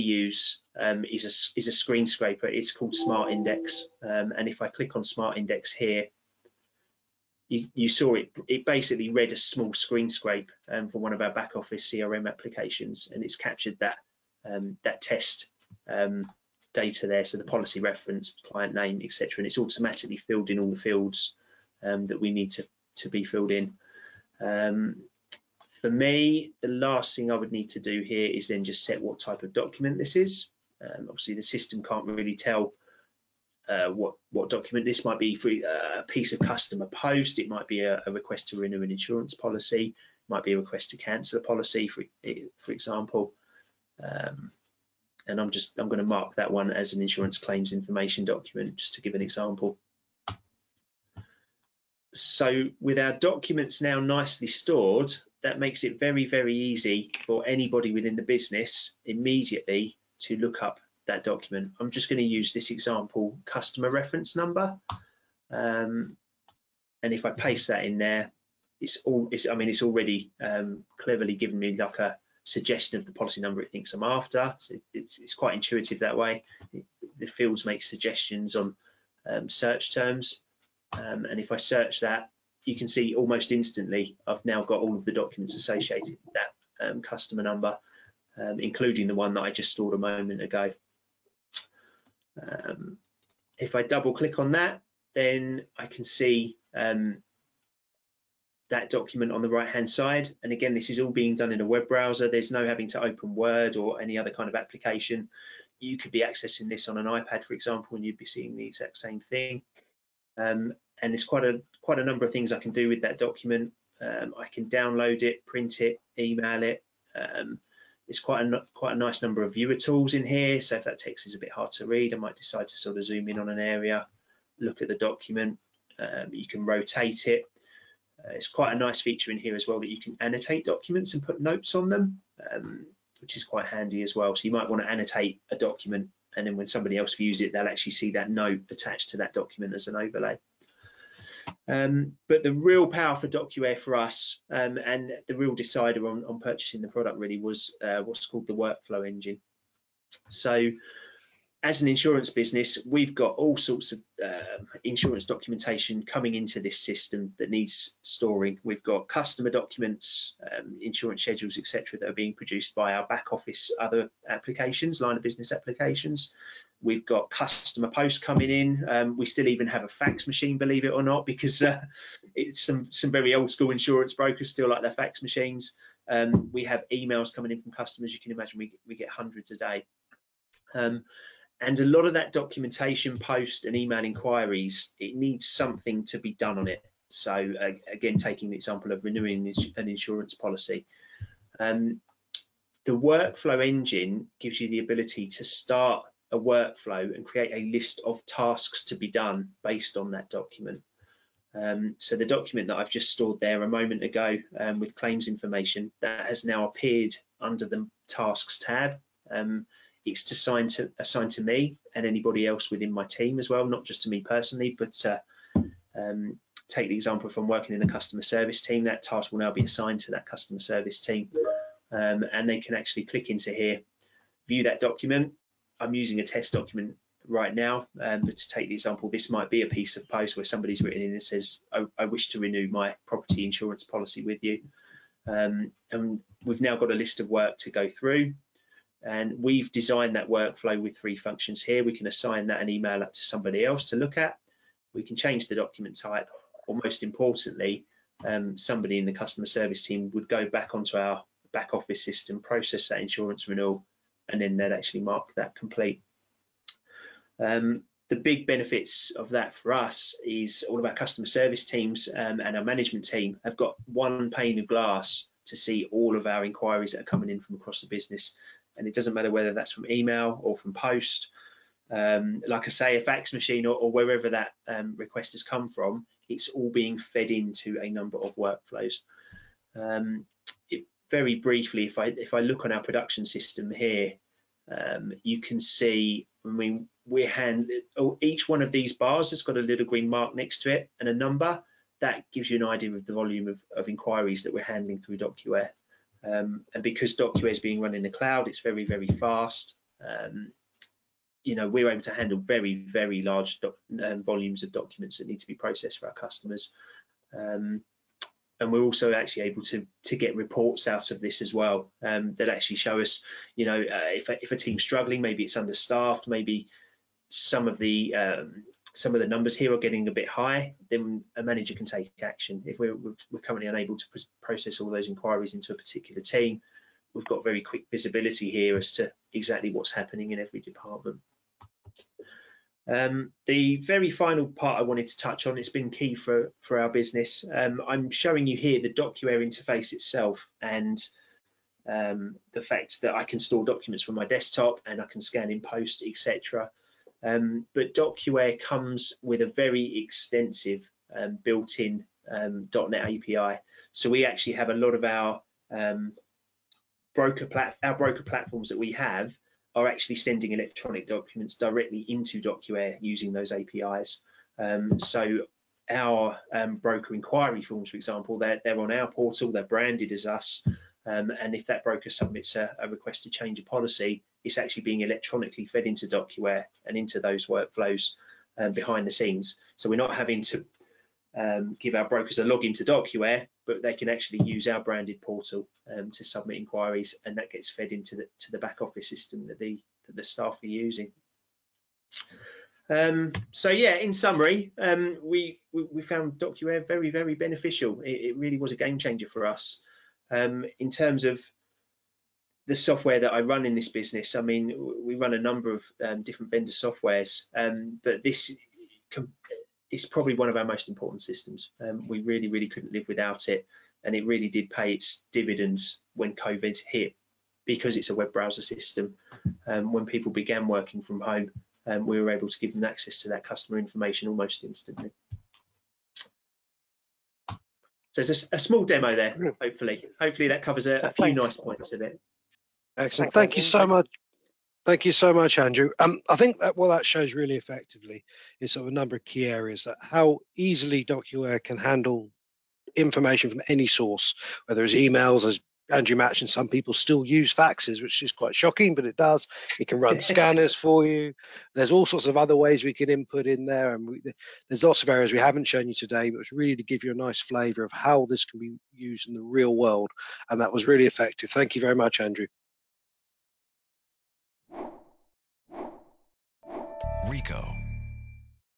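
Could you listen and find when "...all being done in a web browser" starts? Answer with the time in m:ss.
1:40.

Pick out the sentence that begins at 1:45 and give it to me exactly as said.
You could be accessing this on an iPad, for example, and you'd be seeing the exact same thing.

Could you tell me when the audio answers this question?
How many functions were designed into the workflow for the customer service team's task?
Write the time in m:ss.
4:00.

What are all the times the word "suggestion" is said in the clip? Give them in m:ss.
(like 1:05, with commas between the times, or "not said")
1:12, 1:17.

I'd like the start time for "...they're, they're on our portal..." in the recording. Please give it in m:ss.
6:08.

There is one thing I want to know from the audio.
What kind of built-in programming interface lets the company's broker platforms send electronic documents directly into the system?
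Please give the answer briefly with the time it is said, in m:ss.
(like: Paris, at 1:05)
.NET API, at 5:52.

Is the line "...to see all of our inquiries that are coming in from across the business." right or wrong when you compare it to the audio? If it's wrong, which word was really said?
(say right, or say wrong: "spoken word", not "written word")
right.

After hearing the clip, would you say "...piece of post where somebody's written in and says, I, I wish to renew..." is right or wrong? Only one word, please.
right.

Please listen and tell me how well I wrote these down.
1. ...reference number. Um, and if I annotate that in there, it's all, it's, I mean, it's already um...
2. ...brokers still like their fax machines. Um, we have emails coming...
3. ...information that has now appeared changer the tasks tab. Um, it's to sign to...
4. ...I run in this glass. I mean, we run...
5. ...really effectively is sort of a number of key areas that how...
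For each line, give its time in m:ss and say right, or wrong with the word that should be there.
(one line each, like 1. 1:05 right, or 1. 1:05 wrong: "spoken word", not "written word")
1. 1:03 wrong: "paste", not "annotate"
2. 2:54 right
3. 3:25 wrong: "under", not "changer"
4. 6:43 wrong: "business", not "glass"
5. 7:17 right.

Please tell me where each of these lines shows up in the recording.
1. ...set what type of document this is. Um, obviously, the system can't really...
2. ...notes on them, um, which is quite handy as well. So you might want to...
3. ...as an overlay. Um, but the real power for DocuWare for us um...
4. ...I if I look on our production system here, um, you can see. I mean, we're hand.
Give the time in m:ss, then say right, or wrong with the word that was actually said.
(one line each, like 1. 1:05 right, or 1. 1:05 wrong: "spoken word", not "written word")
1. 0:28 right
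2. 2:11 right
3. 2:19 right
4. 4:41 right.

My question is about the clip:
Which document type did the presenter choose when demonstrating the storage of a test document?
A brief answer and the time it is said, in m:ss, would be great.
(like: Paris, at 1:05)
Insurance claims information, at 0:47.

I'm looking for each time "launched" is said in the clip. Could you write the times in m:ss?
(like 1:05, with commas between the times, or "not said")
not said.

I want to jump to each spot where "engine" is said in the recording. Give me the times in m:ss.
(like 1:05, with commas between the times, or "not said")
2:29, 3:13.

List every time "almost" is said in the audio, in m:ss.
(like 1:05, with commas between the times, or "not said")
1:23, 7:04.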